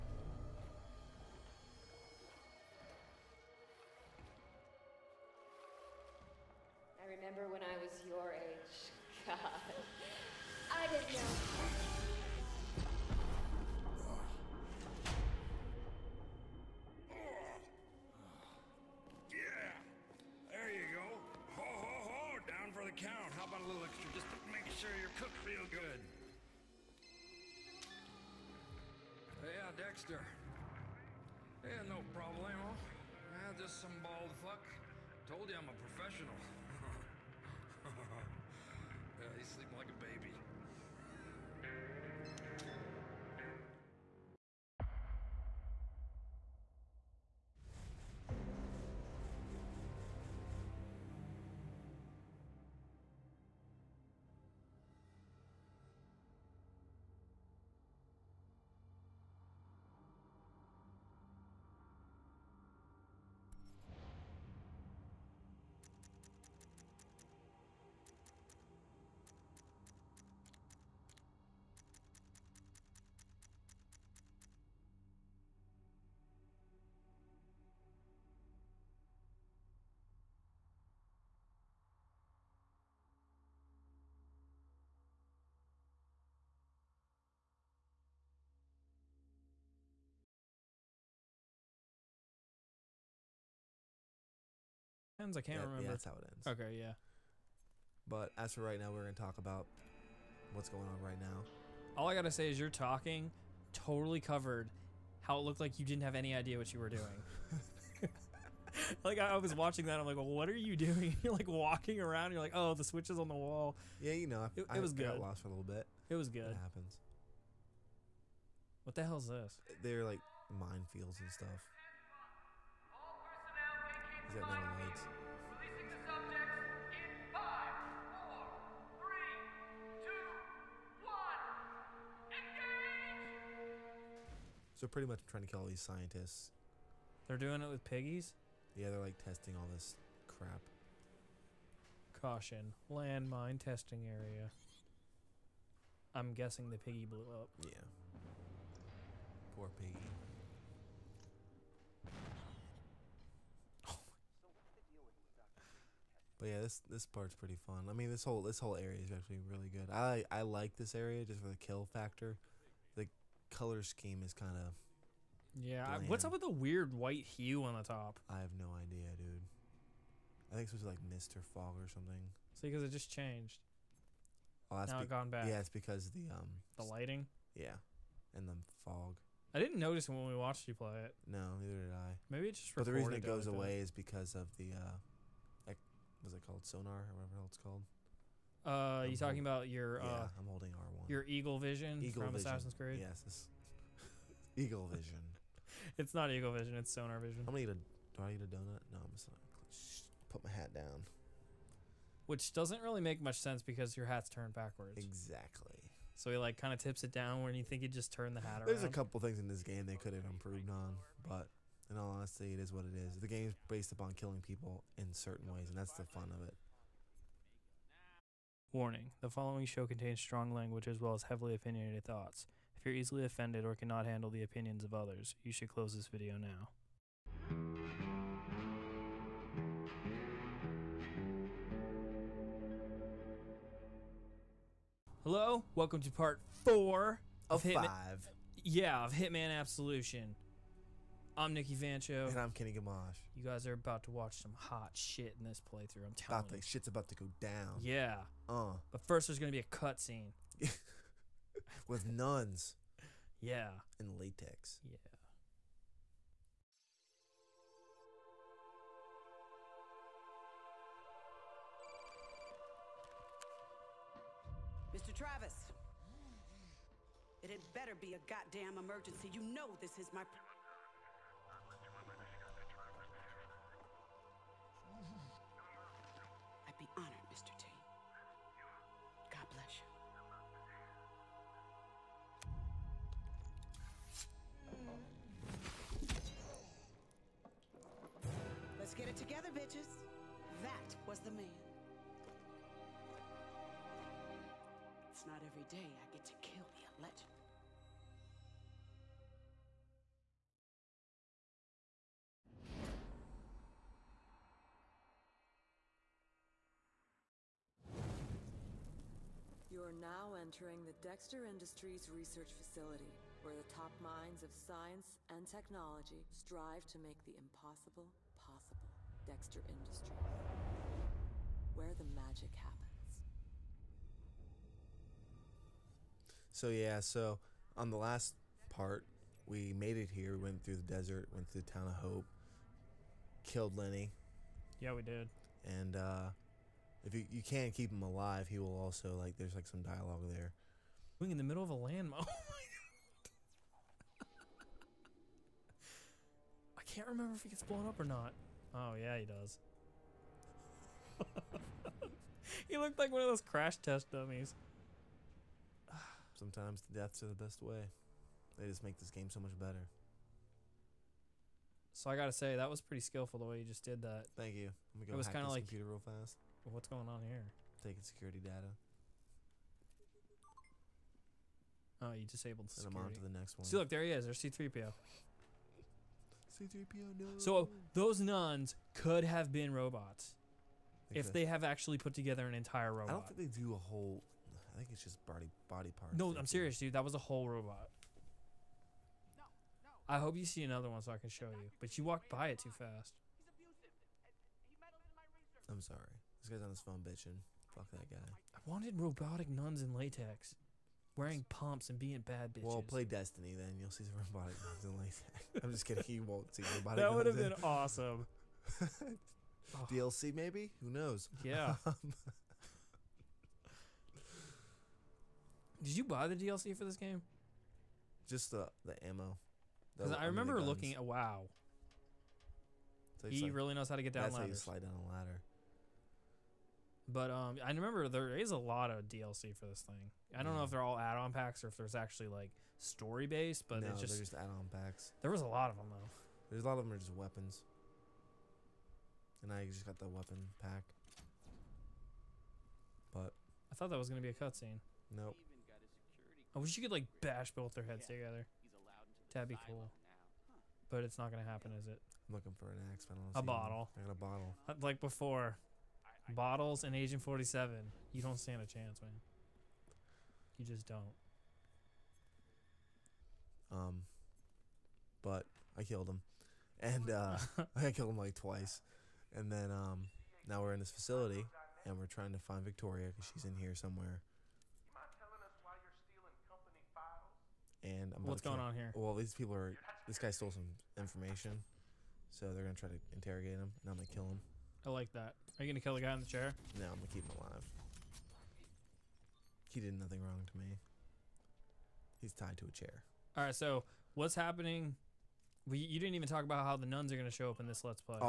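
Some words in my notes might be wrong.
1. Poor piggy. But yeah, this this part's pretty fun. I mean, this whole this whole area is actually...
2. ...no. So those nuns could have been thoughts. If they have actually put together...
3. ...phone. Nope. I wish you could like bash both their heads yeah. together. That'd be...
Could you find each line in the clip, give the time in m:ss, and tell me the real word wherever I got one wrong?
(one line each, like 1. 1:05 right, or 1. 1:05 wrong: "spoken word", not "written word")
1. 2:29 right
2. 6:17 wrong: "robots", not "thoughts"
3. 7:24 wrong: "cutscene", not "phone".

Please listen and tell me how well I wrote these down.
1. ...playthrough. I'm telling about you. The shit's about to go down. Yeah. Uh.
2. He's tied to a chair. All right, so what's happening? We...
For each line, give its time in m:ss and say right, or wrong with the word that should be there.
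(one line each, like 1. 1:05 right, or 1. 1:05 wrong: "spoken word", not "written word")
1. 4:05 right
2. 8:12 right.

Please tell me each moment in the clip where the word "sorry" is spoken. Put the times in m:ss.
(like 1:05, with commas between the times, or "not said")
6:35.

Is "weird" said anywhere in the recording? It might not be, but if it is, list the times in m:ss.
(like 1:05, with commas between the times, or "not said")
2:46.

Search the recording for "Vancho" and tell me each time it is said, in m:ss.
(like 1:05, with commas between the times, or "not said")
4:01.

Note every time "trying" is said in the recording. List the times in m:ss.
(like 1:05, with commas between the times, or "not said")
2:15, 7:52.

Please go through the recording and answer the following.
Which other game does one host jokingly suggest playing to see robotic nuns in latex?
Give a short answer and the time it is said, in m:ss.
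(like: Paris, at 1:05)
Destiny, at 6:43.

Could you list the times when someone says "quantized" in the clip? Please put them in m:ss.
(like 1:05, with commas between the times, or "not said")
not said.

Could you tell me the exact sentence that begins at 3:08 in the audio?
Uh, I'm you talking about your?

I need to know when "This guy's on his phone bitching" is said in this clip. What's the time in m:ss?
6:36.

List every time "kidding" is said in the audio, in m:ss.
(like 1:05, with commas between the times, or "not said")
6:45.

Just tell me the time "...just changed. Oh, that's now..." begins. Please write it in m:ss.
2:52.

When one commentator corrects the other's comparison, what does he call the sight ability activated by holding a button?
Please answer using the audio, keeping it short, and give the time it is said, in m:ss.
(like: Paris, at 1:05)
Sonar Vision, at 3:16.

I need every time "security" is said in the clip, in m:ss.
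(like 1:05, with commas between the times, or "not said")
6:08, 6:12.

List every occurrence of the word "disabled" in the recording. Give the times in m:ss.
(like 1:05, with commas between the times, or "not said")
6:12.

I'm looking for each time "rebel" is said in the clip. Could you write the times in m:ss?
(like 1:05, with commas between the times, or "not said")
not said.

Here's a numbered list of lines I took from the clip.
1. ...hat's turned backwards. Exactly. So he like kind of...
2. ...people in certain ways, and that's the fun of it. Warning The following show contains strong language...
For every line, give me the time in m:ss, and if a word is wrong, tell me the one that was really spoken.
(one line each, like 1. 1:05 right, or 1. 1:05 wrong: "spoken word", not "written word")
1. 3:24 right
2. 3:34 right.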